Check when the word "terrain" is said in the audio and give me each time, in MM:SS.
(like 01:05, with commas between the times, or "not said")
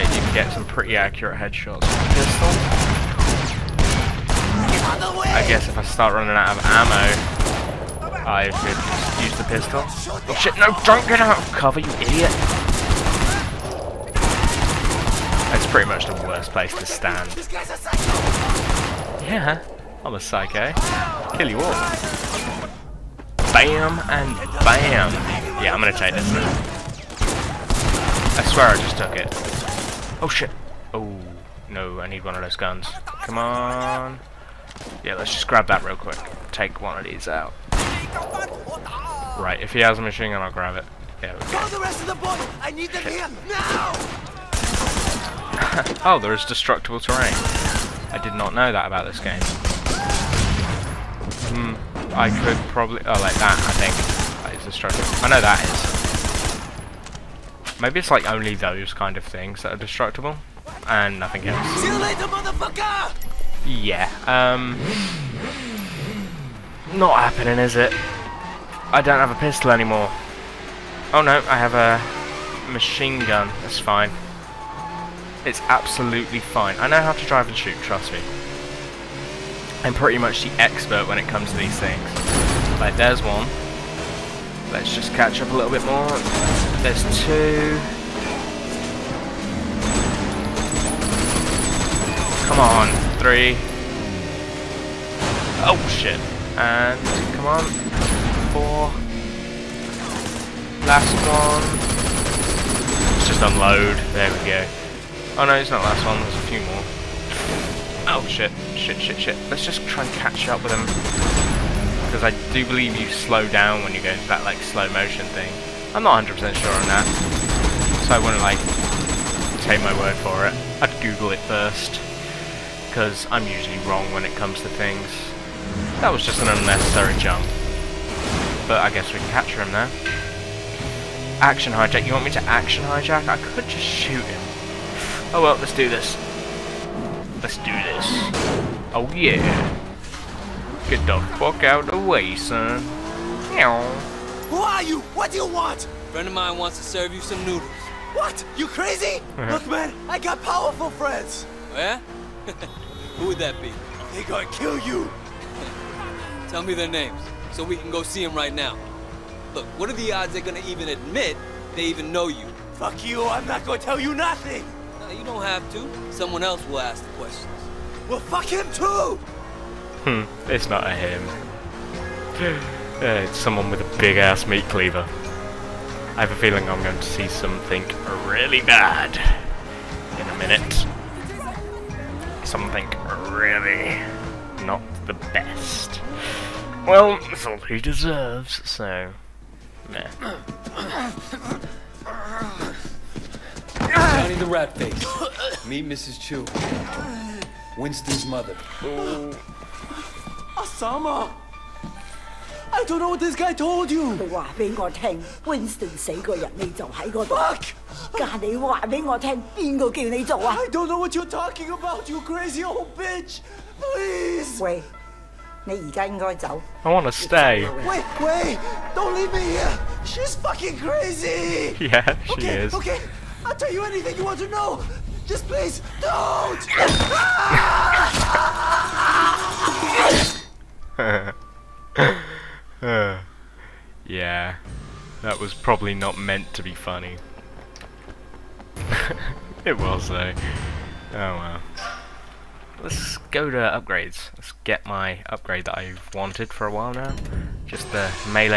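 00:46.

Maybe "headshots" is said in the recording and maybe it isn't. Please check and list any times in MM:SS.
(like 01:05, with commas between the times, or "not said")
00:01.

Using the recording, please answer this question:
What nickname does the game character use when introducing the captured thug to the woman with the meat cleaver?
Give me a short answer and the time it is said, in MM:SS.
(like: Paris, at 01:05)
Johnny the Rat Face, at 03:13.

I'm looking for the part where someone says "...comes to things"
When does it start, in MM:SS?
02:04.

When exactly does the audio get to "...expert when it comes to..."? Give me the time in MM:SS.
01:20.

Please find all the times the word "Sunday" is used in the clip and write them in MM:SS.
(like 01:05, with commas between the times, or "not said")
not said.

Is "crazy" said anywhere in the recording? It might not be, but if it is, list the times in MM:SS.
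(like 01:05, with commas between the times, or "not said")
02:28, 03:32, 03:40.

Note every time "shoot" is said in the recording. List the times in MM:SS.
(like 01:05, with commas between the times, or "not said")
01:17, 02:13.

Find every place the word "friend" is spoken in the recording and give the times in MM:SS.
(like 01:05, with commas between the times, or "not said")
02:26, 02:30.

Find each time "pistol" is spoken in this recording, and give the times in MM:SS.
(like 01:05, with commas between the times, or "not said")
00:02, 00:09, 01:09.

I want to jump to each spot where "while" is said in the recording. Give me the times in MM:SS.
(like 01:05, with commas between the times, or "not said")
04:06.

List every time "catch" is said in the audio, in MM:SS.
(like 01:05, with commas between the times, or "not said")
01:25, 01:50.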